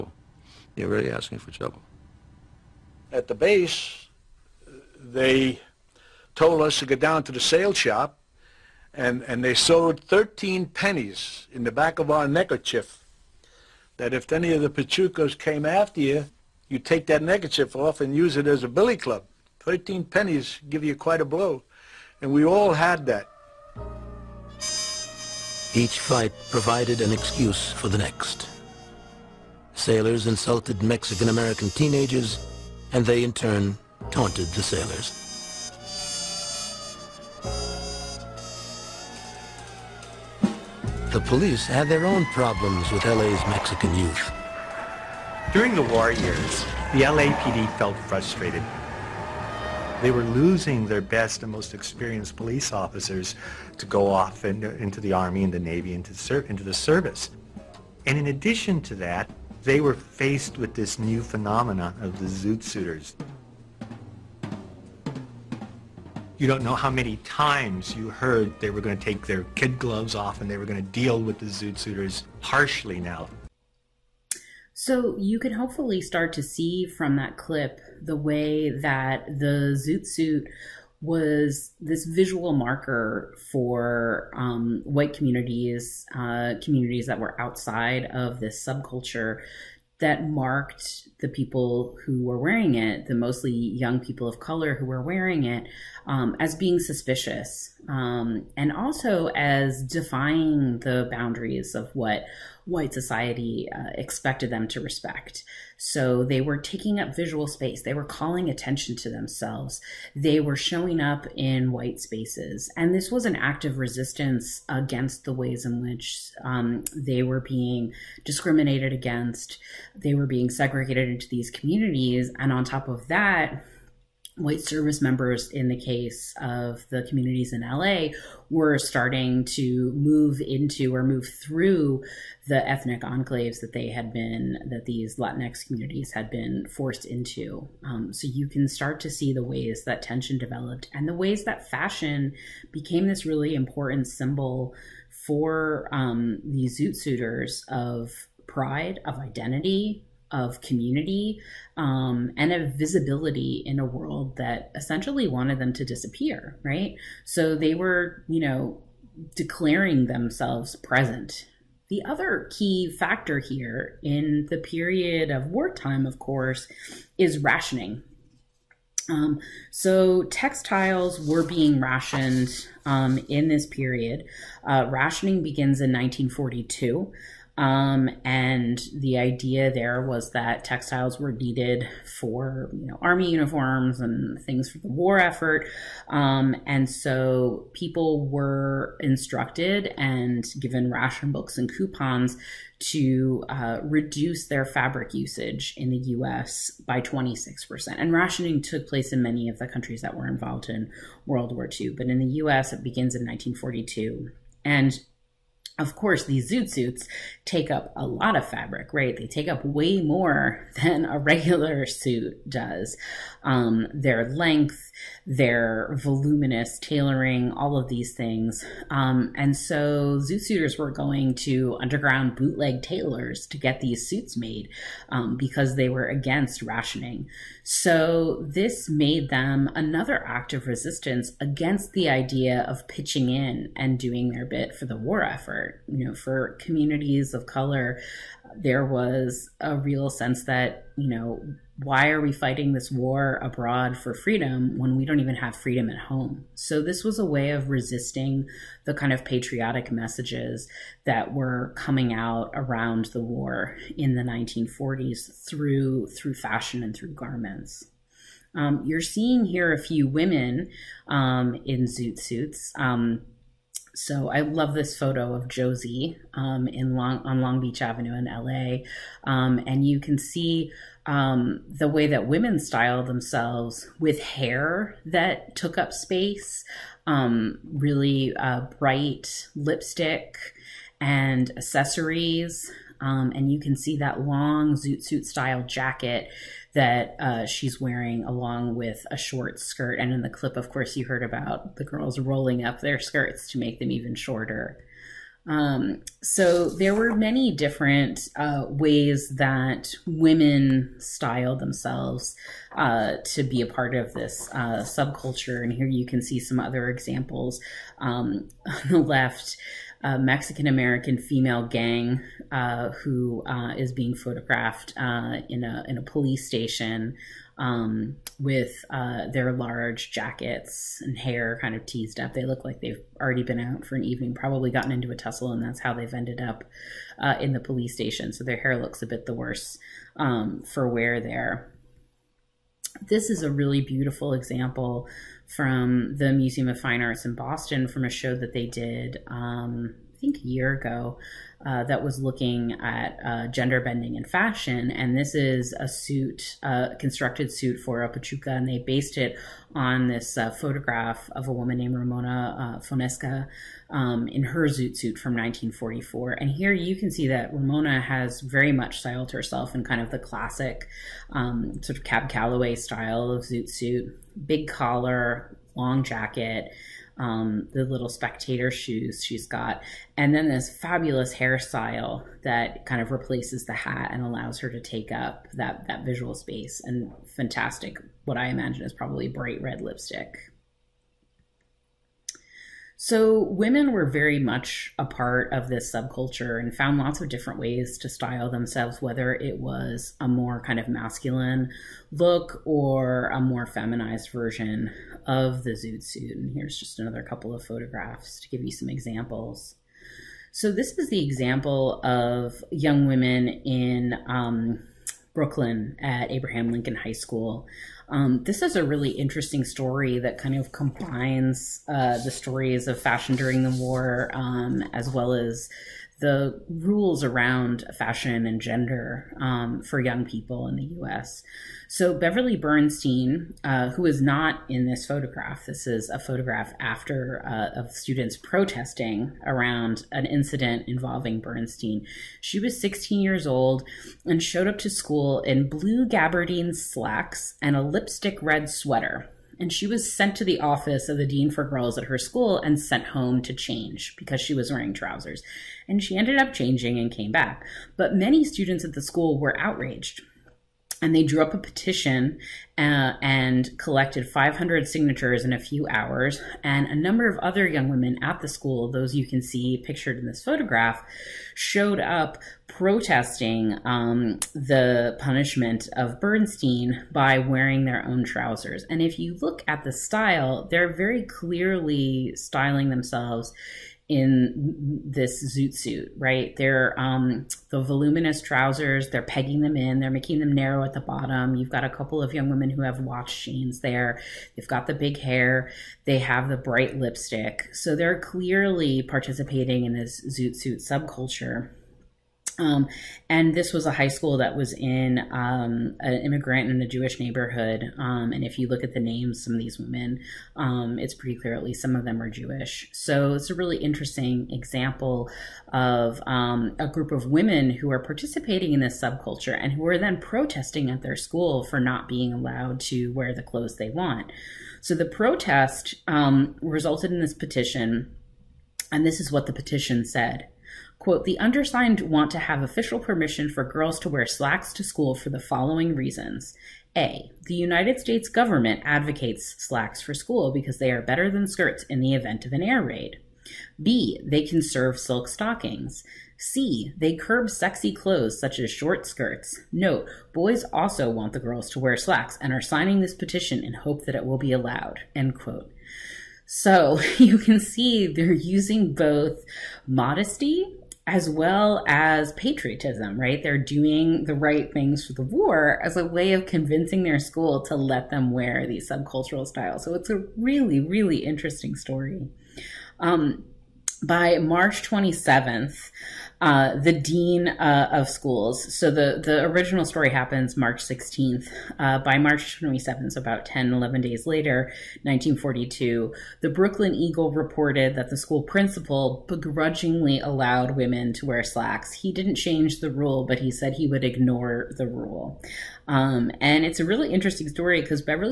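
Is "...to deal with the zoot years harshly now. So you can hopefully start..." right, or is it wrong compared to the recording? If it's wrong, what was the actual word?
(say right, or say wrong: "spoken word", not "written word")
wrong: "suiters", not "years".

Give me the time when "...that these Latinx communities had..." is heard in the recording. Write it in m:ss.
2:14.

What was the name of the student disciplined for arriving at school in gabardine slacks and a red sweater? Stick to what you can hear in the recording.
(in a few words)
Beverly Bernstein.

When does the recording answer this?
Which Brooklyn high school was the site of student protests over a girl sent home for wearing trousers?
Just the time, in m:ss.
6:46.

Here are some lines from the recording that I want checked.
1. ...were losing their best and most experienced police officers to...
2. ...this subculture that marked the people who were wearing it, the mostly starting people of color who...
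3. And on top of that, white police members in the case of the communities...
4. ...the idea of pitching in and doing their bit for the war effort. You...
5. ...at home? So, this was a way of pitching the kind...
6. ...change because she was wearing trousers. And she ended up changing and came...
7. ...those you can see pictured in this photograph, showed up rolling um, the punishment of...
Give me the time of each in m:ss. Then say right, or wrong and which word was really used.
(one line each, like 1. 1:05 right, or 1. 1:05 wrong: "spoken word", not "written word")
1. 0:50 right
2. 1:28 wrong: "young", not "starting"
3. 2:02 wrong: "service", not "police"
4. 3:51 right
5. 4:05 wrong: "resisting", not "pitching"
6. 7:23 right
7. 7:38 wrong: "protesting", not "rolling".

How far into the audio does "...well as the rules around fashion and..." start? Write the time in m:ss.
6:55.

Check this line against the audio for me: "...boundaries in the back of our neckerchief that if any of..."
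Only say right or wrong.
wrong.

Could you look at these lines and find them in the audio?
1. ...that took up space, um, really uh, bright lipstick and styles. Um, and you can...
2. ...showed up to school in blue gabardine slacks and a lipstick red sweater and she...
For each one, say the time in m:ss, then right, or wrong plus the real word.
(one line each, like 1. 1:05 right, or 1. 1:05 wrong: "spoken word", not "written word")
1. 4:35 wrong: "accessories", not "styles"
2. 7:14 right.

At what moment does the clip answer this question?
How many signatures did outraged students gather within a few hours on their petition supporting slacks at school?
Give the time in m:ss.
7:34.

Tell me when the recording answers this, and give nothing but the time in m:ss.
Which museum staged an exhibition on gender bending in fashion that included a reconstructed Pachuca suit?
5:36.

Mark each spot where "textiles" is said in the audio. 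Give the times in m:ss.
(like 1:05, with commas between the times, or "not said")
2:50, 3:00.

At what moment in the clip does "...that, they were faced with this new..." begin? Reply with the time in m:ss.
0:58.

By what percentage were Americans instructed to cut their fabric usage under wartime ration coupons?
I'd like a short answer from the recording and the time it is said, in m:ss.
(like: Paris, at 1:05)
26%, at 3:17.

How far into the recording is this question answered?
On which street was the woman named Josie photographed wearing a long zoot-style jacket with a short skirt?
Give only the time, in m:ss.
4:27.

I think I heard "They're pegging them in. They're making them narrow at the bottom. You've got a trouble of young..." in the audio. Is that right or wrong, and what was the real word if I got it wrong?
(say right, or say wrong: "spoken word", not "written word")
wrong: "couple", not "trouble".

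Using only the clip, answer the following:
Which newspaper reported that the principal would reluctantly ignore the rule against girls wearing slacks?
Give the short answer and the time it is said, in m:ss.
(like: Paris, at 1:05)
Brooklyn Eagle, at 9:36.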